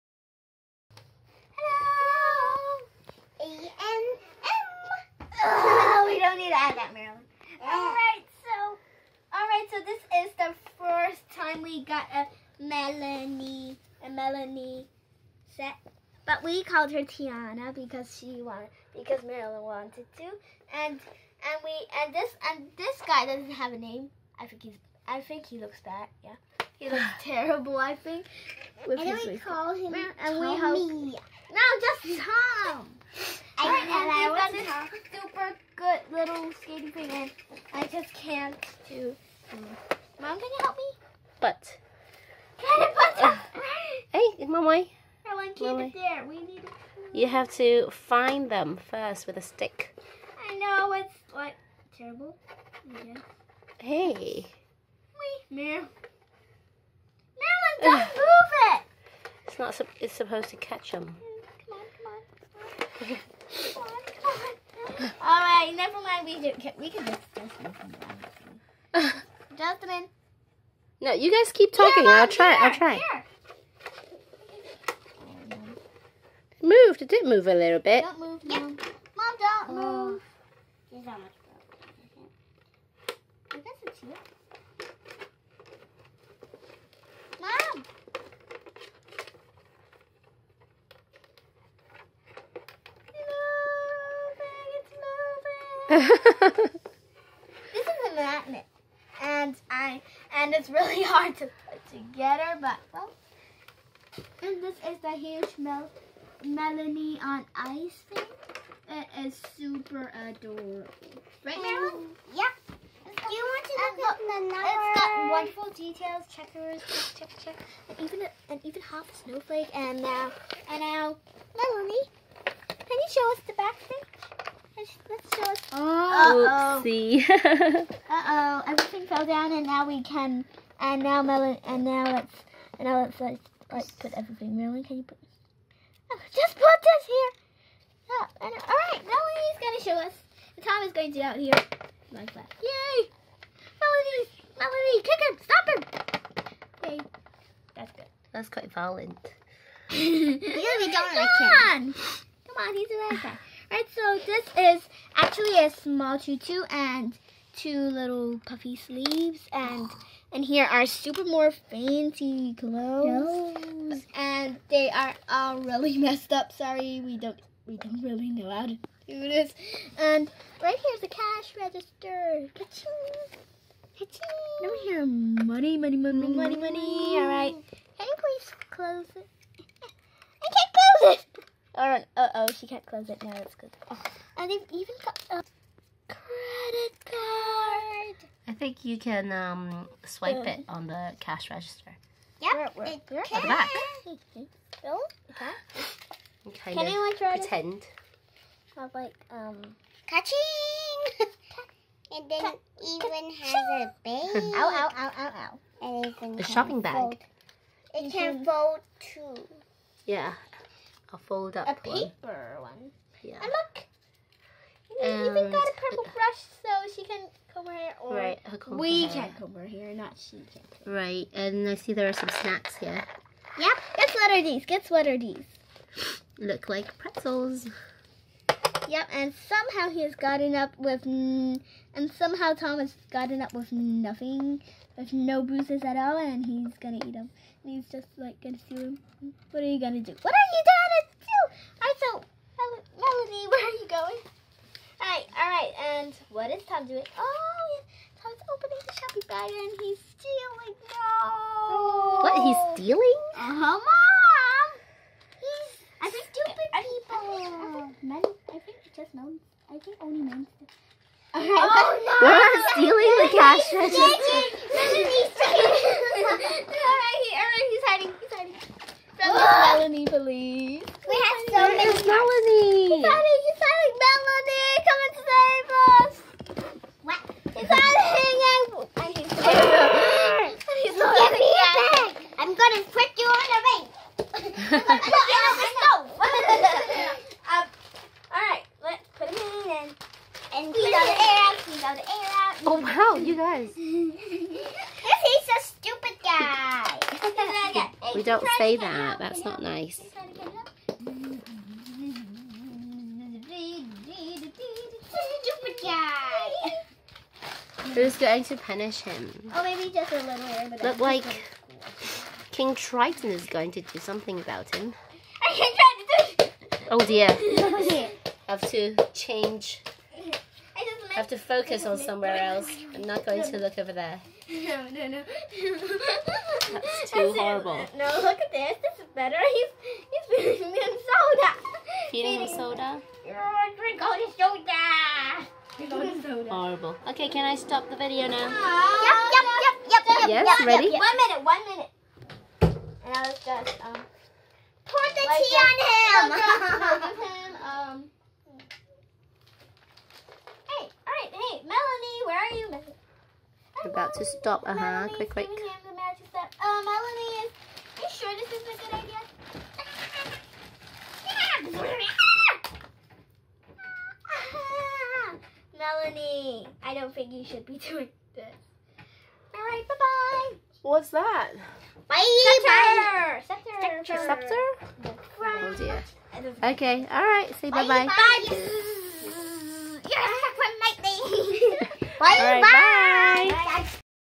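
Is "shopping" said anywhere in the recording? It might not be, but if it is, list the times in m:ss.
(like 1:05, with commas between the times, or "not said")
3:26, 4:08.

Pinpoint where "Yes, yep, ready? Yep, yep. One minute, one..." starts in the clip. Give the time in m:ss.
5:40.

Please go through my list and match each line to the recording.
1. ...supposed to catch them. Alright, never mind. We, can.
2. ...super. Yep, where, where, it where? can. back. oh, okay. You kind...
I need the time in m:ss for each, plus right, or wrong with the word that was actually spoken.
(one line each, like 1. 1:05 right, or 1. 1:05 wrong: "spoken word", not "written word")
1. 1:00 right
2. 3:11 wrong: "register", not "super".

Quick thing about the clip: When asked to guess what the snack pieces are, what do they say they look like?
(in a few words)
pretzels.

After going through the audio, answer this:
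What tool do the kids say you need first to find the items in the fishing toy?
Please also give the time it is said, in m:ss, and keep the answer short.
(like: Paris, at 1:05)
a stick, at 0:49.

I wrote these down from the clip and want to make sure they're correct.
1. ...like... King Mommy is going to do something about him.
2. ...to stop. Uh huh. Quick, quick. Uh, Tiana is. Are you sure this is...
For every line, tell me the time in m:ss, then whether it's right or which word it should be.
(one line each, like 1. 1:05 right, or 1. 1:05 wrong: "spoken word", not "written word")
1. 5:10 wrong: "Triton", not "Mommy"
2. 5:54 wrong: "Melanie", not "Tiana".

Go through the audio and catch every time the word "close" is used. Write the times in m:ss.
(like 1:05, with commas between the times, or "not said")
2:58, 3:02.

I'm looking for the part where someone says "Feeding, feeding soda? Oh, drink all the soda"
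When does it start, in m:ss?
5:32.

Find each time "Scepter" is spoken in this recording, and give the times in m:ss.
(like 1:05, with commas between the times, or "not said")
6:14.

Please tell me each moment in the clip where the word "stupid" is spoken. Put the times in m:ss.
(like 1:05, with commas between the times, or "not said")
4:16, 4:55.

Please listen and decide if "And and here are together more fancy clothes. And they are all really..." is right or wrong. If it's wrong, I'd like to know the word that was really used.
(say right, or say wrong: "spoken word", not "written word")
wrong: "super", not "together".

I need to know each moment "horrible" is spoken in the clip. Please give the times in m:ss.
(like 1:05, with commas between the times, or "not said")
5:27, 5:36.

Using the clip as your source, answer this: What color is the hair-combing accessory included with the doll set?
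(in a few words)
purple.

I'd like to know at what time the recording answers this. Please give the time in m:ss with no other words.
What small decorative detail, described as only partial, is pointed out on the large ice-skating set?
1:58.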